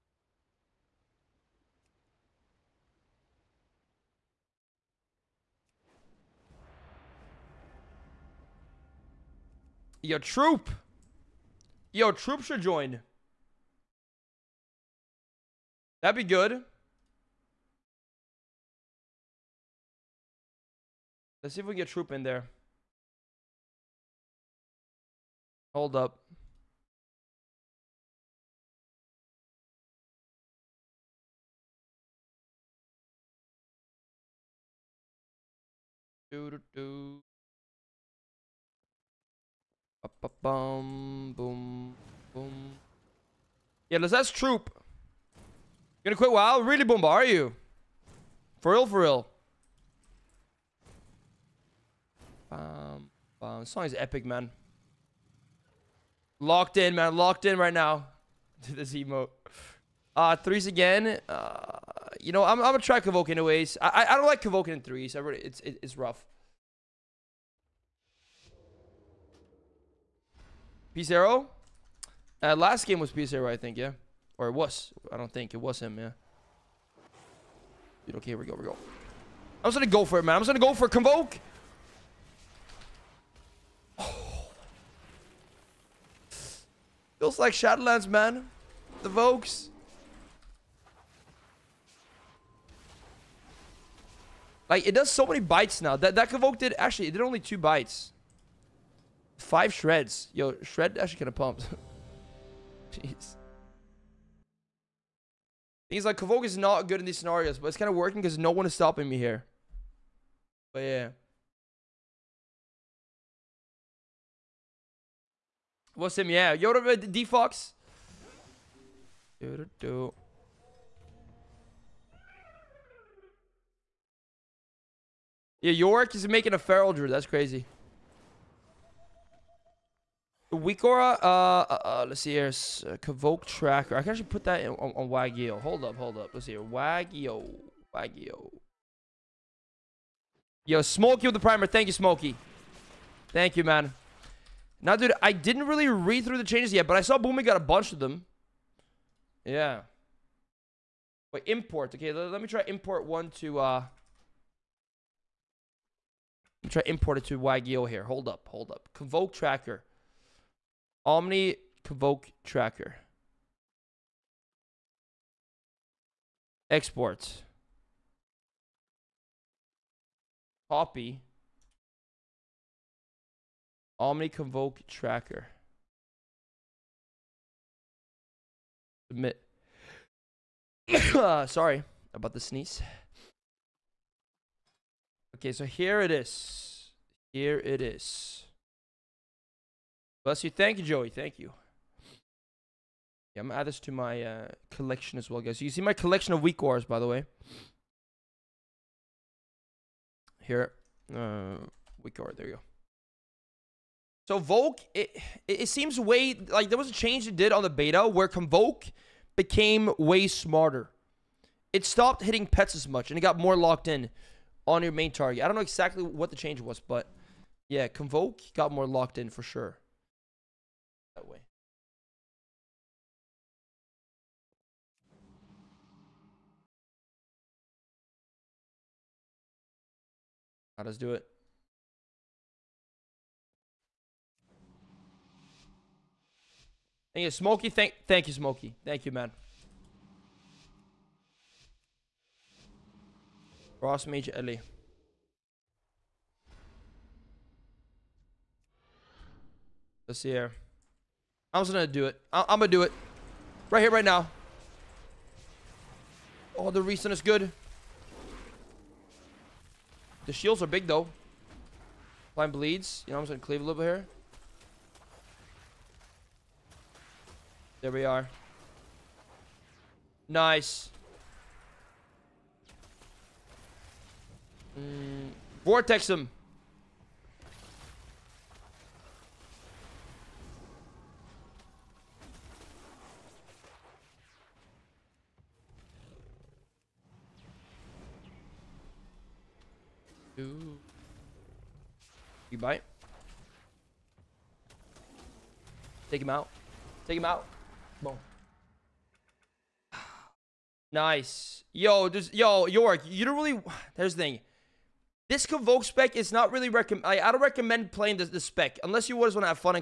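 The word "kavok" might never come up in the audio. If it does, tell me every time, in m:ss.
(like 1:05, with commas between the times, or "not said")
1:36, 1:46.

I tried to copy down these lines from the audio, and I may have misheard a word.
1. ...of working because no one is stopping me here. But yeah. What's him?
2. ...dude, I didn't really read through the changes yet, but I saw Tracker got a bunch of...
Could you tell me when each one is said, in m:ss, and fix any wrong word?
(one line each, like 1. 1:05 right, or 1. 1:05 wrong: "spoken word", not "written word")
1. 1:47 right
2. 2:24 wrong: "Boomy", not "Tracker".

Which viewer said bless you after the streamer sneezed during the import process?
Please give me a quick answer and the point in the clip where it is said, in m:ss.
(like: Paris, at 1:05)
Joey, at 3:10.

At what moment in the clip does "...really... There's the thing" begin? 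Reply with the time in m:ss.
5:03.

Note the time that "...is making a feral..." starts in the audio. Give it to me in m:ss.
2:06.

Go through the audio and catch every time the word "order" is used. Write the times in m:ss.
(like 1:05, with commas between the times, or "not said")
not said.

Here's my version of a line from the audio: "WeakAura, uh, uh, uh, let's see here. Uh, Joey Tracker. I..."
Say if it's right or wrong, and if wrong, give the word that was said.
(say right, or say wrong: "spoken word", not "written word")
wrong: "Convoke", not "Joey".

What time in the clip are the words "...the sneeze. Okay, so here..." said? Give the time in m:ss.
3:02.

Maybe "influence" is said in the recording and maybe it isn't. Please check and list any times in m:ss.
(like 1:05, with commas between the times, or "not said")
not said.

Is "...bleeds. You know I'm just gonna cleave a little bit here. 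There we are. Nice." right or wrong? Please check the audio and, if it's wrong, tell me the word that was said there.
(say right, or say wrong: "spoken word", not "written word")
right.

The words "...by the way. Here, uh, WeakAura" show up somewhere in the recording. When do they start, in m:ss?
3:16.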